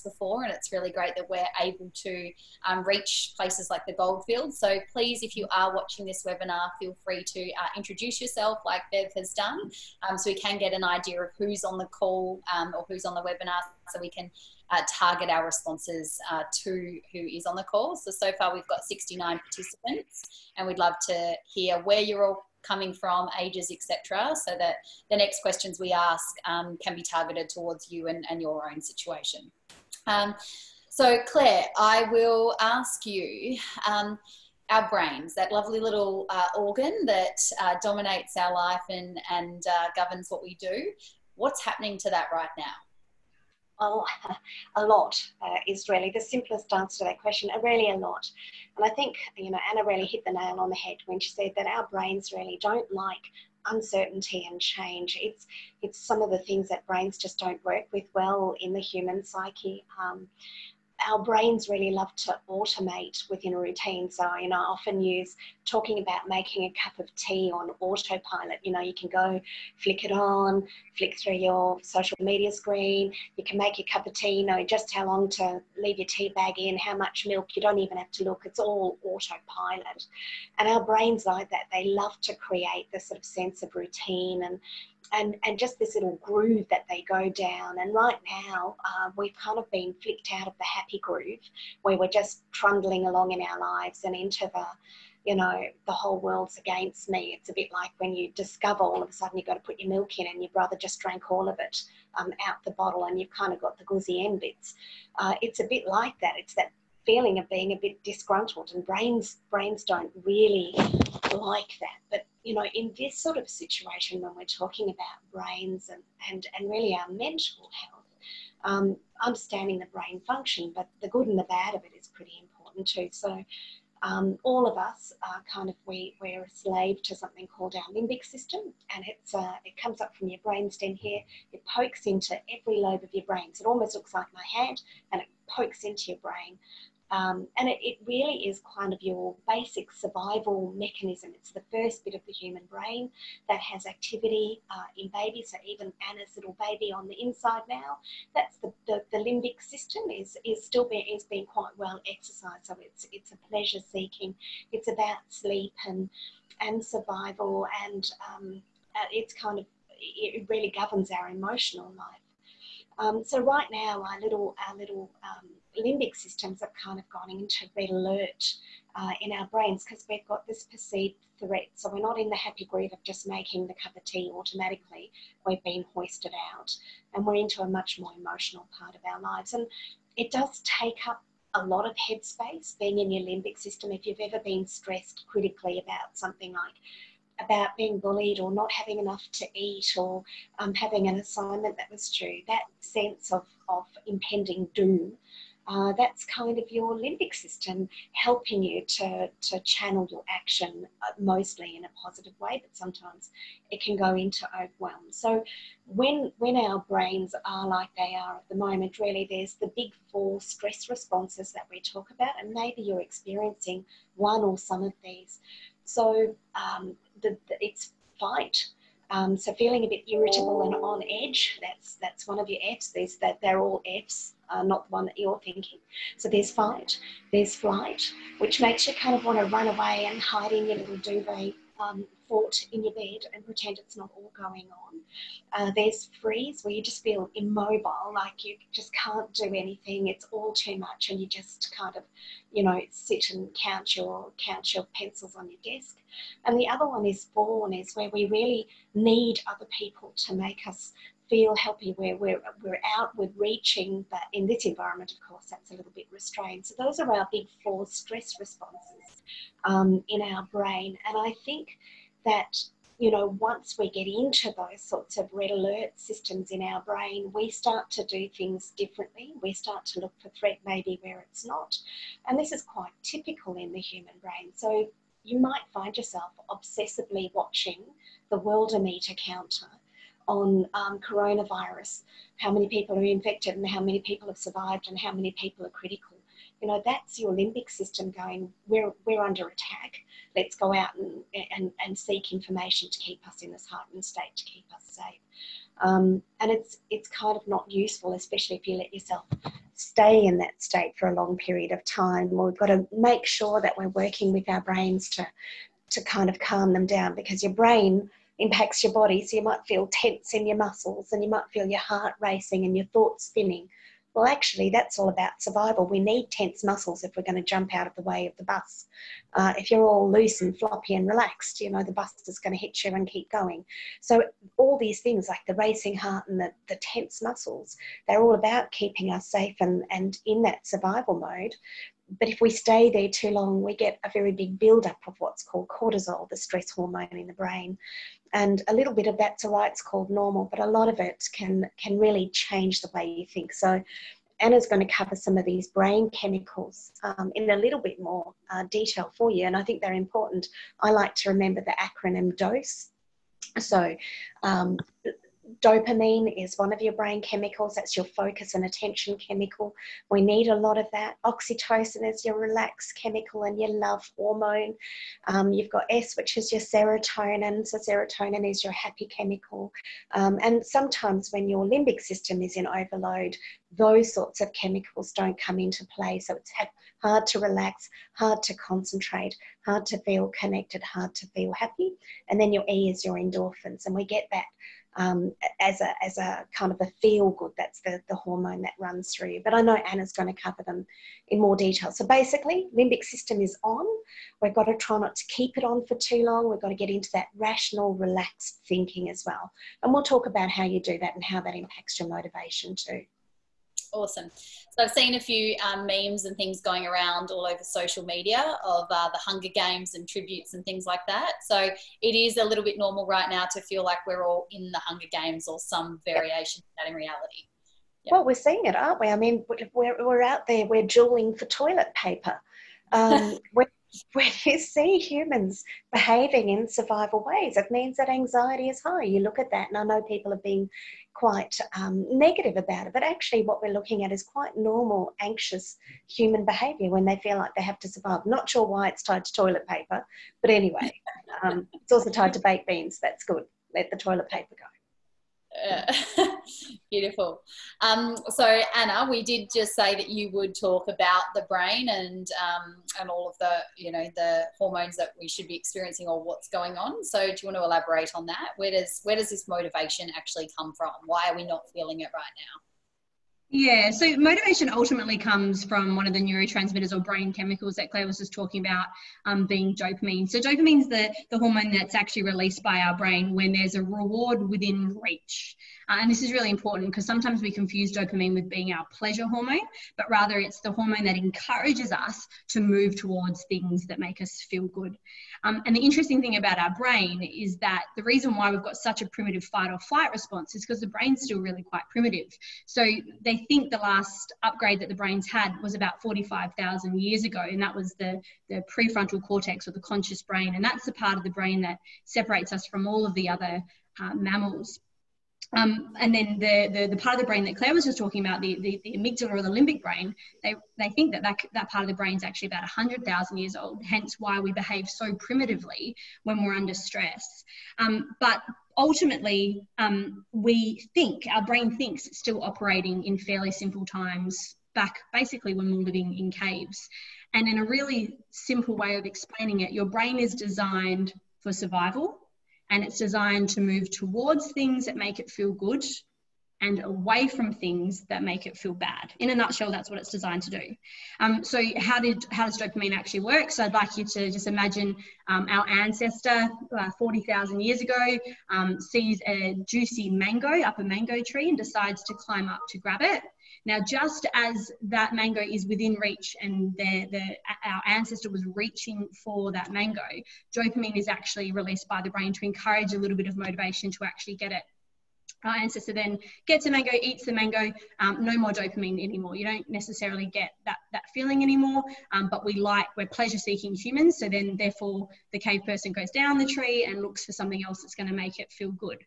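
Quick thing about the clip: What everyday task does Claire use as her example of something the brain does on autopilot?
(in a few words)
making a cup of tea.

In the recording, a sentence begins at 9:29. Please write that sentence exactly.
You don't necessarily get that, that feeling anymore, um, but we like, we're pleasure seeking humans.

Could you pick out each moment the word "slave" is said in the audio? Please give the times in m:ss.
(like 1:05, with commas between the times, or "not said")
2:06.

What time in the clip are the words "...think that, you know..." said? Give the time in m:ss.
4:21.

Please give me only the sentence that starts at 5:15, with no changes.
We need tense muscles if we're going to jump out of the way of the bus.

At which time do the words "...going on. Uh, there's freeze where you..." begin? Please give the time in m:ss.
3:54.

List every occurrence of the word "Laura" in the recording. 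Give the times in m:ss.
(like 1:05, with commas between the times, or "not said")
not said.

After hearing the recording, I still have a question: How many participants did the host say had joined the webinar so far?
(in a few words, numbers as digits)
69.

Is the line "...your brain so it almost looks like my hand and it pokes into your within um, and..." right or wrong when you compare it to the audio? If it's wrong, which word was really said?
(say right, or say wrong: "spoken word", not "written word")
wrong: "brain", not "within".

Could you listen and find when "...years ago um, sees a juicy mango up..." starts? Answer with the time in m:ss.
9:07.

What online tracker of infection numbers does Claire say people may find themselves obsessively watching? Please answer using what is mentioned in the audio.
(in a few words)
worldometer.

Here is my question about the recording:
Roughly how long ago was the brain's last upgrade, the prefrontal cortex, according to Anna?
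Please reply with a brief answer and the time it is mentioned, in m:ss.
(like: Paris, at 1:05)
45,000 years ago, at 8:16.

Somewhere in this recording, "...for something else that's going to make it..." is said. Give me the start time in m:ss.
9:37.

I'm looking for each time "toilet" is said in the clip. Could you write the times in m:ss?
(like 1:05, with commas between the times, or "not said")
7:01, 7:19, 7:23.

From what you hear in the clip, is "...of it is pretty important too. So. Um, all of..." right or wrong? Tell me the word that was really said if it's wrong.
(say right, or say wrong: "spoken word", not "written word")
right.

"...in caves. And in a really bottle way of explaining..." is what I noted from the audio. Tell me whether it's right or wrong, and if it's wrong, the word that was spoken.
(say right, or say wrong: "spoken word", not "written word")
wrong: "simple", not "bottle".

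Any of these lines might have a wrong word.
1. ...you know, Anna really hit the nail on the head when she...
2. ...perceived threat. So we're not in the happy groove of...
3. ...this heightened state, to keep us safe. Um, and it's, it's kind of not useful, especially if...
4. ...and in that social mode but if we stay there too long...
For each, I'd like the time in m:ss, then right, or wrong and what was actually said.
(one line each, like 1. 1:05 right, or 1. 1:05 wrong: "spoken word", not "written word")
1. 0:49 right
2. 2:50 right
3. 4:53 right
4. 5:29 wrong: "survival", not "social".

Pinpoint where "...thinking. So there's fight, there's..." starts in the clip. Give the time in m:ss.
3:45.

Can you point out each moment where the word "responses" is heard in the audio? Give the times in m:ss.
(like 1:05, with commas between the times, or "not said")
0:15, 3:30, 4:18, 8:10.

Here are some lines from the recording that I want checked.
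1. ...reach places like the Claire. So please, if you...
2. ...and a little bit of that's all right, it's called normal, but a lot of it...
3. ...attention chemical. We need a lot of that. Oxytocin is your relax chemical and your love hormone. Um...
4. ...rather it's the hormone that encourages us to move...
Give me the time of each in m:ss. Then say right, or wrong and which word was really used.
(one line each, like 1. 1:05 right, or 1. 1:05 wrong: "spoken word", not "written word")
1. 0:02 wrong: "Goldfield", not "Claire"
2. 5:38 right
3. 5:58 right
4. 8:00 right.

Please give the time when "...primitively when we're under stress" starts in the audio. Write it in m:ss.
8:35.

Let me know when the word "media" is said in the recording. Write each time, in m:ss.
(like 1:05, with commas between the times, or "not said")
1:12, 6:48.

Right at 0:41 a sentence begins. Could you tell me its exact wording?
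What's happening to that right now?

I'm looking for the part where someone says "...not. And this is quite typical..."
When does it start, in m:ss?
4:31.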